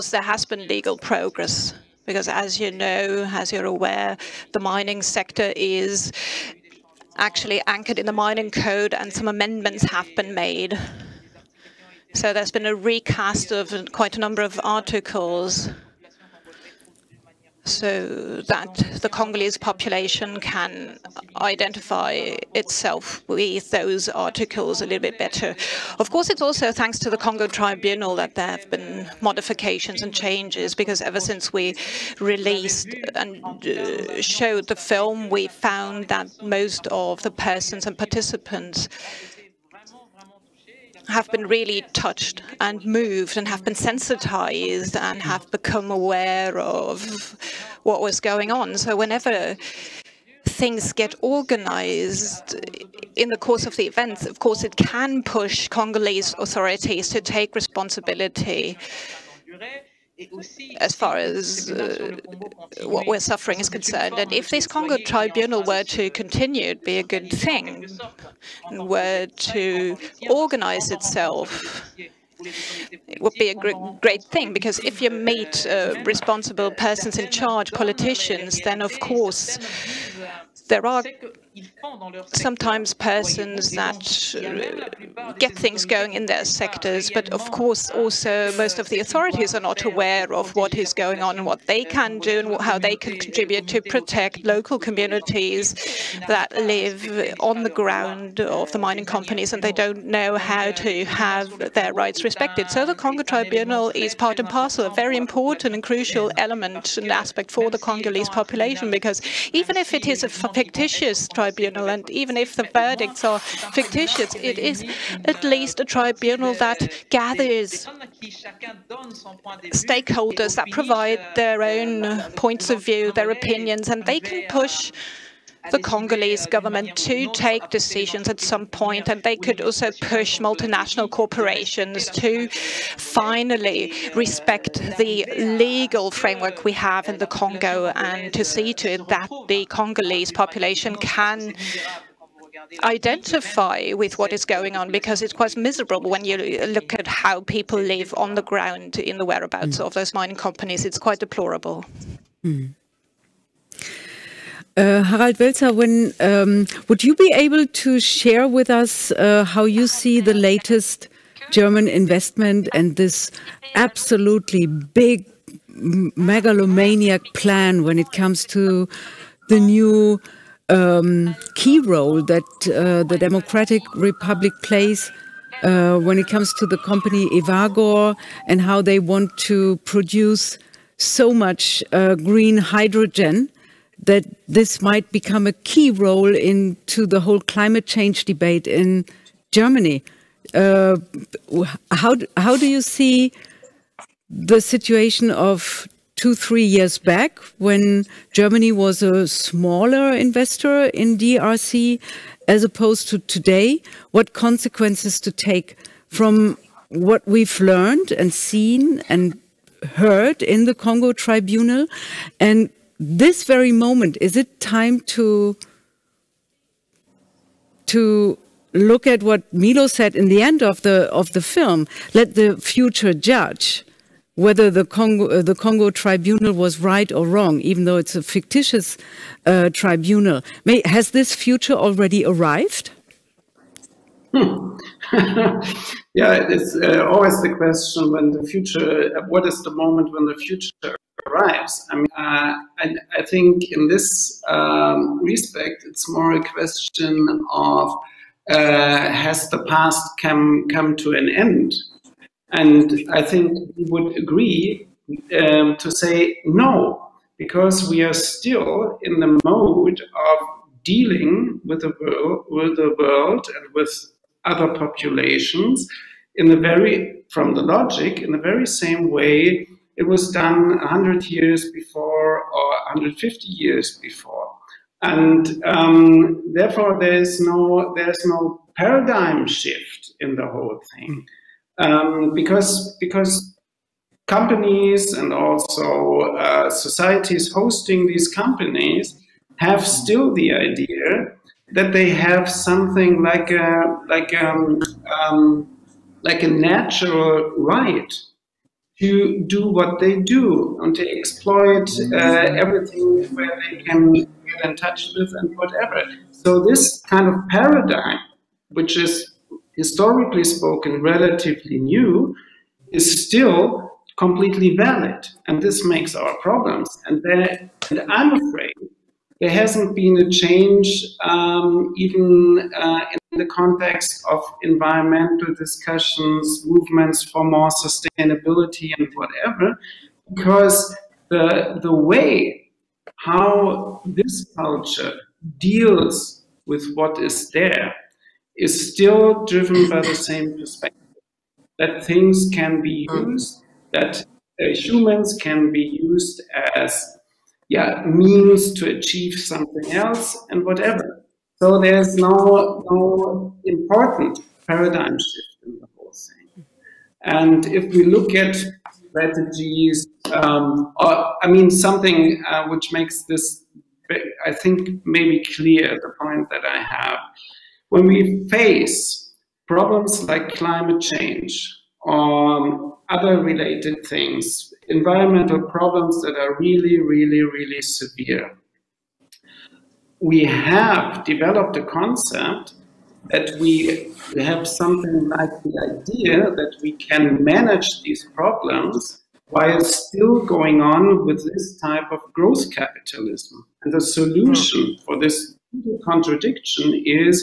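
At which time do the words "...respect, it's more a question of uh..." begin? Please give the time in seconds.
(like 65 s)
245 s.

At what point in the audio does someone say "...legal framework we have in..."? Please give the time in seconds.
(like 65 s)
135 s.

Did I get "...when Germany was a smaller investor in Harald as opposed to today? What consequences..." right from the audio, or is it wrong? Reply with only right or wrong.
wrong.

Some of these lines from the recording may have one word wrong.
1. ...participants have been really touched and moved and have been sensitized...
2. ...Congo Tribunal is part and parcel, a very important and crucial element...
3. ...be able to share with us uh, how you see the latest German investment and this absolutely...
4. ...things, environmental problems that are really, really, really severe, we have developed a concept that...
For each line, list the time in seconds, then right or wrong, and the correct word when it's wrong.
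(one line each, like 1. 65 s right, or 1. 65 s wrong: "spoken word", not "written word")
1. 37 s right
2. 102 s right
3. 157 s right
4. 374 s right.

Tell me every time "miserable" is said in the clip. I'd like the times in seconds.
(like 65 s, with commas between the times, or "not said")
145 s.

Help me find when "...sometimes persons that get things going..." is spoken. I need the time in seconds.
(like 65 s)
82 s.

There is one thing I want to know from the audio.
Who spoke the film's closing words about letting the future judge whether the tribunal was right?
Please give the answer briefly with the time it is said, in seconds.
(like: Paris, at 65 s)
Milo, at 219 s.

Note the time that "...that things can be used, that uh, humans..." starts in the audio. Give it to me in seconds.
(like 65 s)
341 s.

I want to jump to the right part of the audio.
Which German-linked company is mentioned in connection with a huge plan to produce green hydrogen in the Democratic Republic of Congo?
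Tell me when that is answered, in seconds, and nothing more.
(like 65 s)
177 s.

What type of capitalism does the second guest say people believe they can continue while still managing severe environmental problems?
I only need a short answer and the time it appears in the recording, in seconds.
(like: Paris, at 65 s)
growth capitalism, at 392 s.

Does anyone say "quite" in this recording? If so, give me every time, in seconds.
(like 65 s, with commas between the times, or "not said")
13 s, 145 s, 150 s.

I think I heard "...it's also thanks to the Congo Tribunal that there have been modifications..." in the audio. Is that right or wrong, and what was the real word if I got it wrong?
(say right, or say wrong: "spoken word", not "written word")
right.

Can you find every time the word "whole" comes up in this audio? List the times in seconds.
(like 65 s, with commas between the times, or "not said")
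187 s, 280 s, 355 s.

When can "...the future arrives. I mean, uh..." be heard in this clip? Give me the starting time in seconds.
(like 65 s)
240 s.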